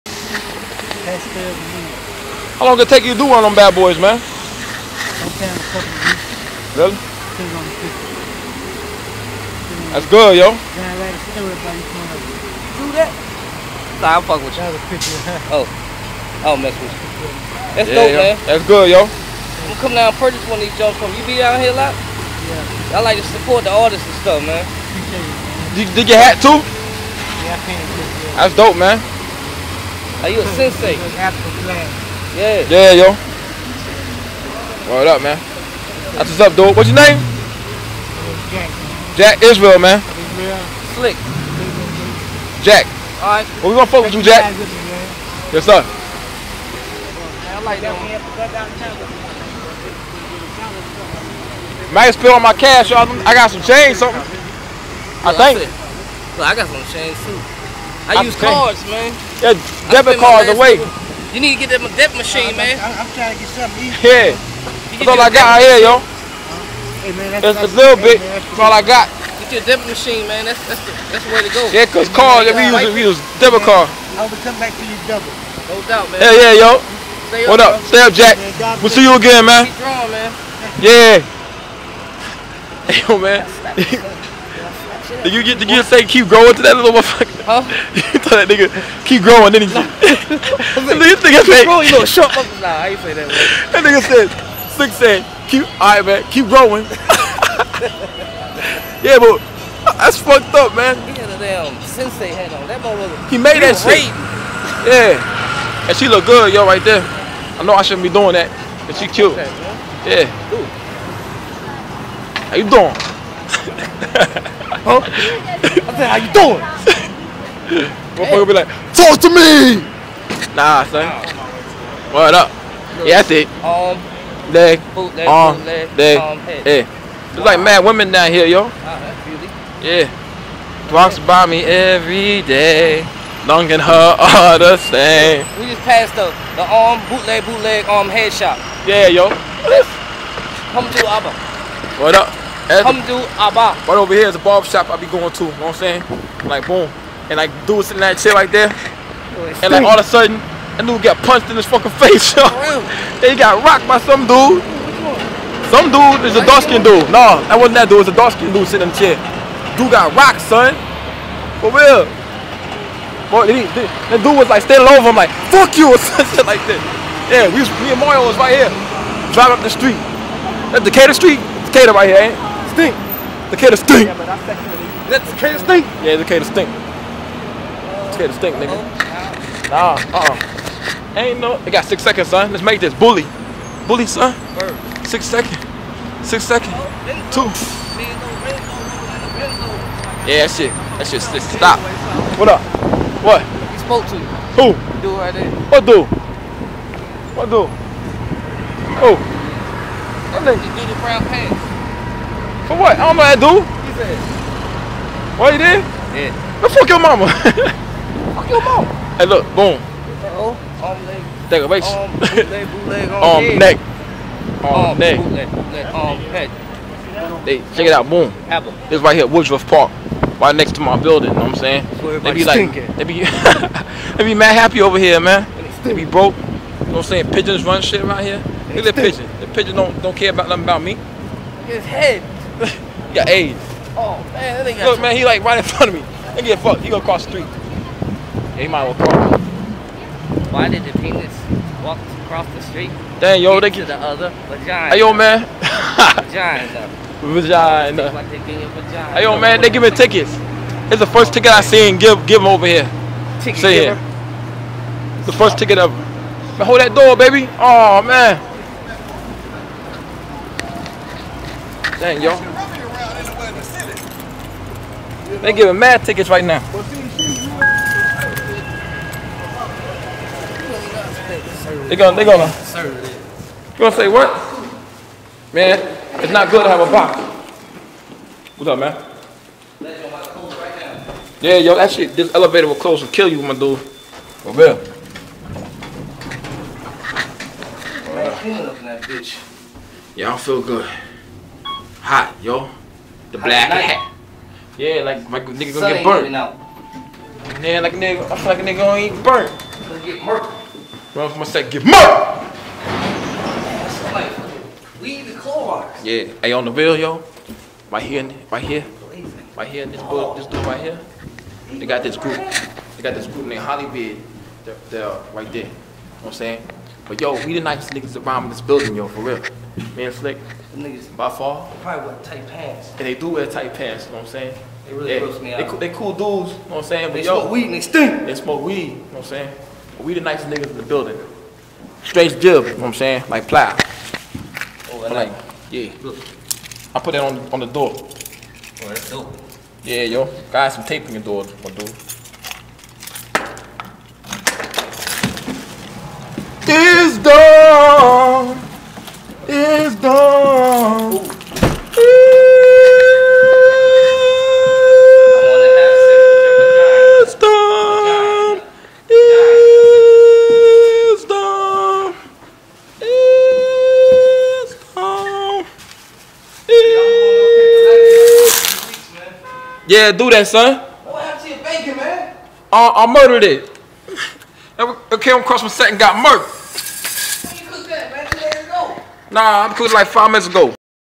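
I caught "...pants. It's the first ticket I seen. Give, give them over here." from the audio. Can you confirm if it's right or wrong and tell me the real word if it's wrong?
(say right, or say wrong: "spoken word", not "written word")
wrong: "tickets", not "pants".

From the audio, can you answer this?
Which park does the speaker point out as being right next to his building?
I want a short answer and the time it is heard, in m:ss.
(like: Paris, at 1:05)
Woodruff Park, at 3:39.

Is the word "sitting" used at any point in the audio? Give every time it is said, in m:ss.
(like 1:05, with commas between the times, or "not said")
2:27, 2:38.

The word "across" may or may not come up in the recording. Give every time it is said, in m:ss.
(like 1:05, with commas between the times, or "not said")
4:02, 6:15.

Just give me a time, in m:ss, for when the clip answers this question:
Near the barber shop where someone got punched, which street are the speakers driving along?
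2:50.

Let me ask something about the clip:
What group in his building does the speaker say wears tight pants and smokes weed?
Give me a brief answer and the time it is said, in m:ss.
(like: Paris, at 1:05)
Hollywood, at 5:13.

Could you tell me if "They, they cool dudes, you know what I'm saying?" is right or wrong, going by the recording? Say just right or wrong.
right.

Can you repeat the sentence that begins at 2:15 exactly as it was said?
We just passed the, the arm, um, bootleg, bootleg, arm, um, head shop.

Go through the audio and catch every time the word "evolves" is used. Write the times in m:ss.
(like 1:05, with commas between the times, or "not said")
not said.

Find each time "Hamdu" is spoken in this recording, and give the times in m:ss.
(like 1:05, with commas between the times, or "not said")
2:22.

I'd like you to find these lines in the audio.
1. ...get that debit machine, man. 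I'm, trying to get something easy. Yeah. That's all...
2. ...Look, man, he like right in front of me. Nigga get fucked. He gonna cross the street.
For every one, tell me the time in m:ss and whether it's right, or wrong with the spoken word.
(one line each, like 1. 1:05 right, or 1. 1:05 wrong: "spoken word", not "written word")
1. 1:01 right
2. 3:54 right.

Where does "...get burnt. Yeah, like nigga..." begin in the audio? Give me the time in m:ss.
4:55.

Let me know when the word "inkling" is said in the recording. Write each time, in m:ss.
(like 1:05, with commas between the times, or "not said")
not said.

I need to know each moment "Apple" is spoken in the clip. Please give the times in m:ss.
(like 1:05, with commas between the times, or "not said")
3:38.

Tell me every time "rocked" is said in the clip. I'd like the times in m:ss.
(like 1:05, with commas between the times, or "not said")
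2:33, 2:40.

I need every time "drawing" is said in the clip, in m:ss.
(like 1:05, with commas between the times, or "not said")
1:19.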